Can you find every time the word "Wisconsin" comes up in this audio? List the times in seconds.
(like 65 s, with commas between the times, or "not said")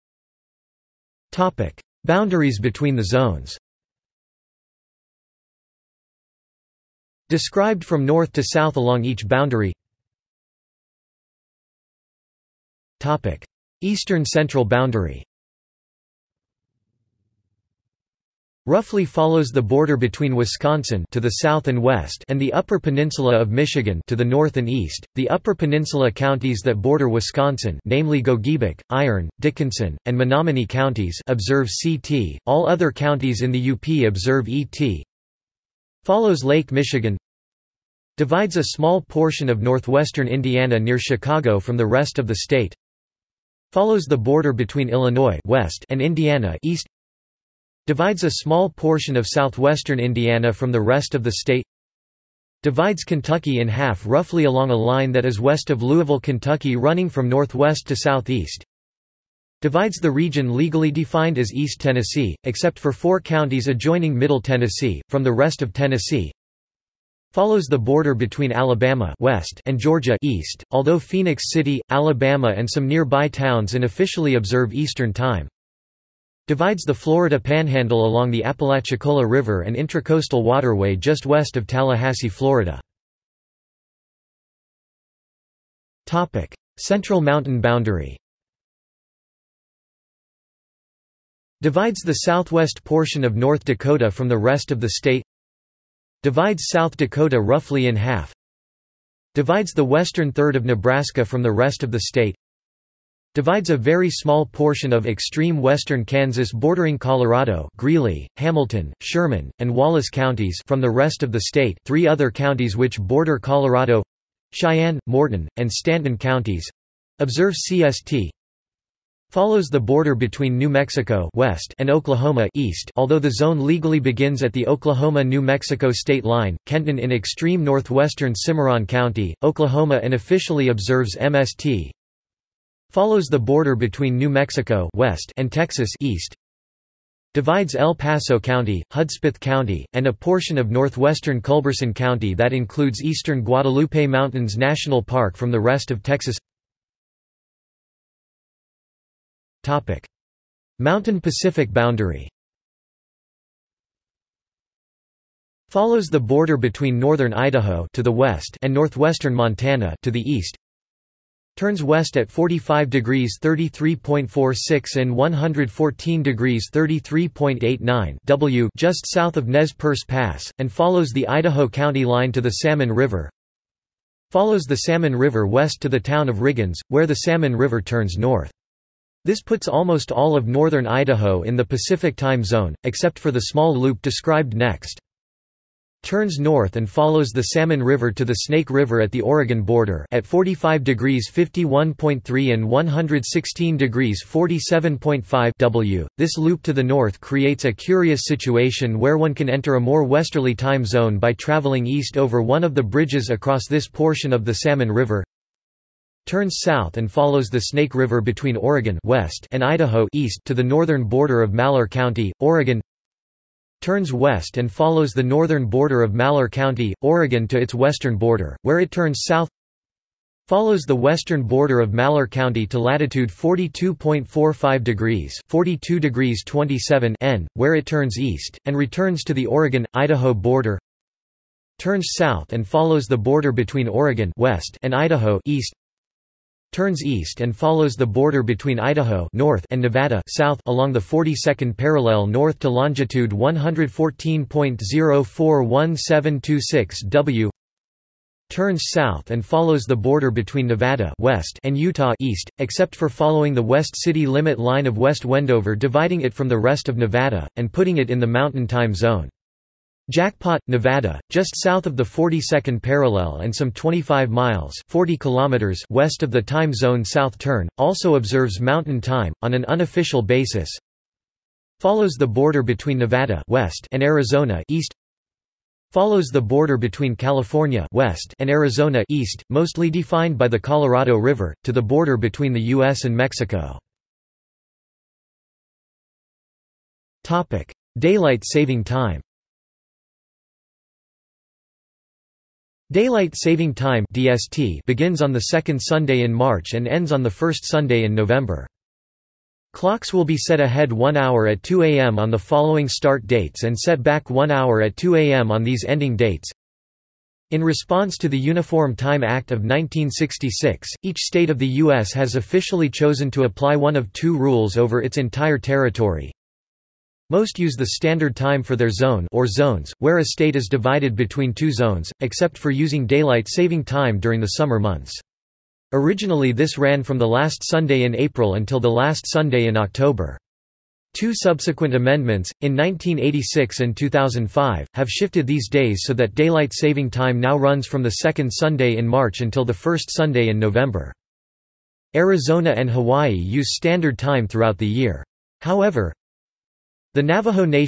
20 s, 27 s.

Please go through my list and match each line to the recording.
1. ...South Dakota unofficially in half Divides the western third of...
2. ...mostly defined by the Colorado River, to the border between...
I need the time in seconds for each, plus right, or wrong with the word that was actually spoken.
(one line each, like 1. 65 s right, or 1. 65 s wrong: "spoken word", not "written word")
1. 96 s wrong: "roughly", not "unofficially"
2. 279 s right.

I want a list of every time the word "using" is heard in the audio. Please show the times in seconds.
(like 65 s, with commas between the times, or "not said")
322 s.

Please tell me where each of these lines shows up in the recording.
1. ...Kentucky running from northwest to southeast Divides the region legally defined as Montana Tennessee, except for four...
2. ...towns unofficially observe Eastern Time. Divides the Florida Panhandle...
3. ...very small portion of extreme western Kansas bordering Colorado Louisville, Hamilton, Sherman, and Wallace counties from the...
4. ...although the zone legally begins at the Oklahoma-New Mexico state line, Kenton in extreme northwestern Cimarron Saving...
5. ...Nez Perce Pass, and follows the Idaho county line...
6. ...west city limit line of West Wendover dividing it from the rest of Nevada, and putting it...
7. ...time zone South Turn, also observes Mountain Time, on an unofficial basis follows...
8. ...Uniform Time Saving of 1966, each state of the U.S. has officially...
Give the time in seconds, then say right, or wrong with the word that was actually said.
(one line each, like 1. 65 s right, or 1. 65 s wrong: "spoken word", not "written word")
1. 56 s wrong: "East", not "Montana"
2. 73 s right
3. 103 s wrong: "Greeley", not "Louisville"
4. 122 s wrong: "County", not "Saving"
5. 169 s right
6. 253 s right
7. 266 s right
8. 308 s wrong: "Act", not "Saving".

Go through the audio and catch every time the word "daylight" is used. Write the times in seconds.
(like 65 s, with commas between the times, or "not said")
287 s, 292 s, 323 s, 336 s.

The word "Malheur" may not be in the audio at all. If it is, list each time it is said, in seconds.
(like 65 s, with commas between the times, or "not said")
211 s, 216 s, 221 s.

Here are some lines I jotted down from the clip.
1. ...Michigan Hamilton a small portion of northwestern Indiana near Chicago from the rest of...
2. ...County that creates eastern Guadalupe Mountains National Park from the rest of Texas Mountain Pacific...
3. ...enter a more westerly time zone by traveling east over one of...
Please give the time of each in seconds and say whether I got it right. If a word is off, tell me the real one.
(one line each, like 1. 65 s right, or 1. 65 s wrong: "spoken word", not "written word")
1. 36 s wrong: "Divides", not "Hamilton"
2. 141 s wrong: "includes", not "creates"
3. 199 s right.